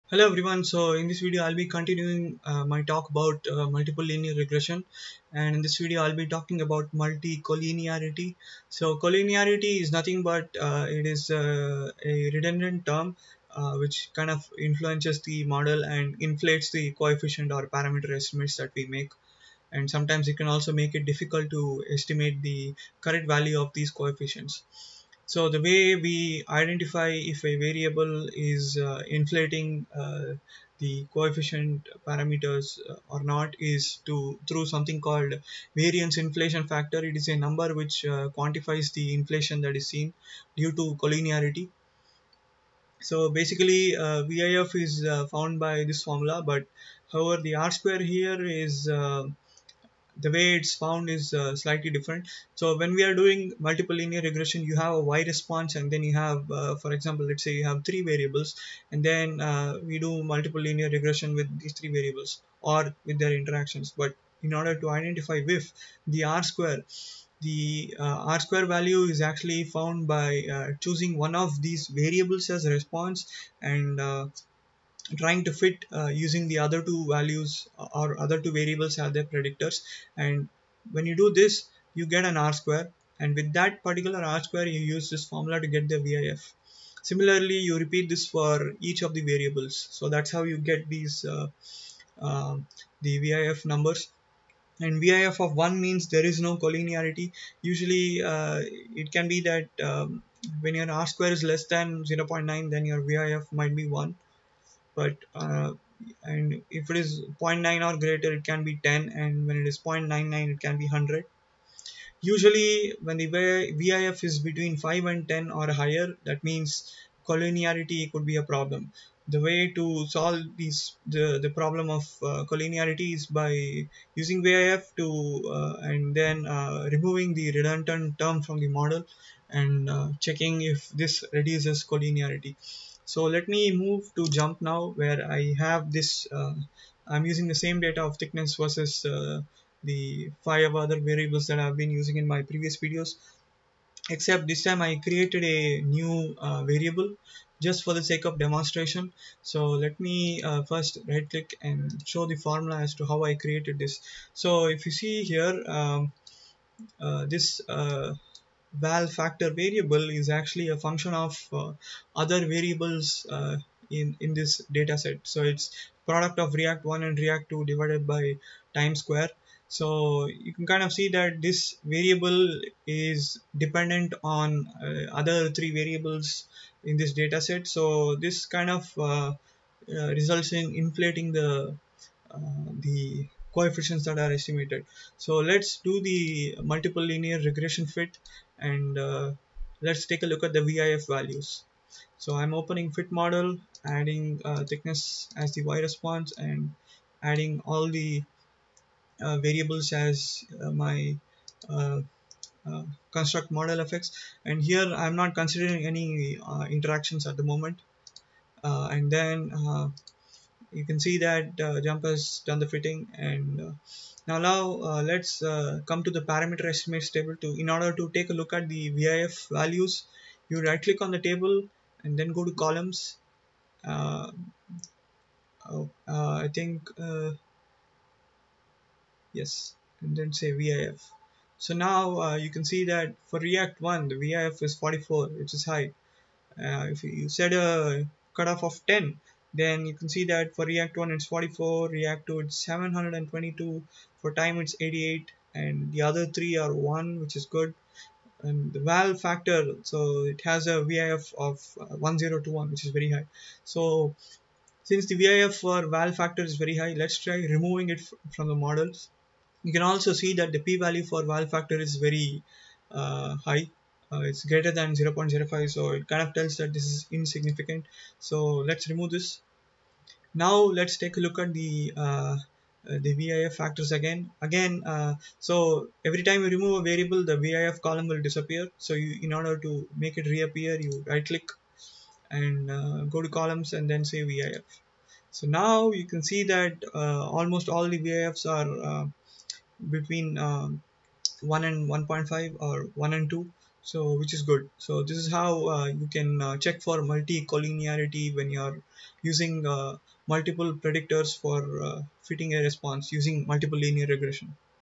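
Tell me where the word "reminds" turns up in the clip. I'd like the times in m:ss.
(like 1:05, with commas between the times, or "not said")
not said.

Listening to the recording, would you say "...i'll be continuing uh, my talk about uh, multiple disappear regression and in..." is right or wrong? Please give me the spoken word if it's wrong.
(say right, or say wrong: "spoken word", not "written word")
wrong: "linear", not "disappear".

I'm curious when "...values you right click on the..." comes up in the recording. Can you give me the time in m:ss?
3:39.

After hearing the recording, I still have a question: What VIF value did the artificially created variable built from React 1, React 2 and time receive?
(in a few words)
1021.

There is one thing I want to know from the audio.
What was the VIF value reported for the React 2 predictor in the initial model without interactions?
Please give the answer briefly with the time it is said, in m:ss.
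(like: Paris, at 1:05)
722, at 4:02.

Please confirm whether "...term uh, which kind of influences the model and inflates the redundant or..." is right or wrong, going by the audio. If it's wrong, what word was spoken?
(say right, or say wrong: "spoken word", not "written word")
wrong: "coefficient", not "redundant".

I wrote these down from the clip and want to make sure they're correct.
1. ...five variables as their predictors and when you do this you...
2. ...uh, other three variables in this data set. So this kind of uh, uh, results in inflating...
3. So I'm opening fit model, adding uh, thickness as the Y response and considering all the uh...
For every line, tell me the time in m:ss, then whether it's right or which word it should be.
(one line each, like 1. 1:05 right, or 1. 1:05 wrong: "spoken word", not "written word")
1. 1:18 wrong: "two", not "five"
2. 2:54 right
3. 3:12 wrong: "adding", not "considering".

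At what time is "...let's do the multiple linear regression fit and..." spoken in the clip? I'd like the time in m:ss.
3:05.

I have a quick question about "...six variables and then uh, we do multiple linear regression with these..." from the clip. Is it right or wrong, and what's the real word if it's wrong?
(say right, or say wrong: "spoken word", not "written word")
wrong: "three", not "six".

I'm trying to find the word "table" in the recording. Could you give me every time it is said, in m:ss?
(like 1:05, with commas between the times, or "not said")
3:37, 3:41.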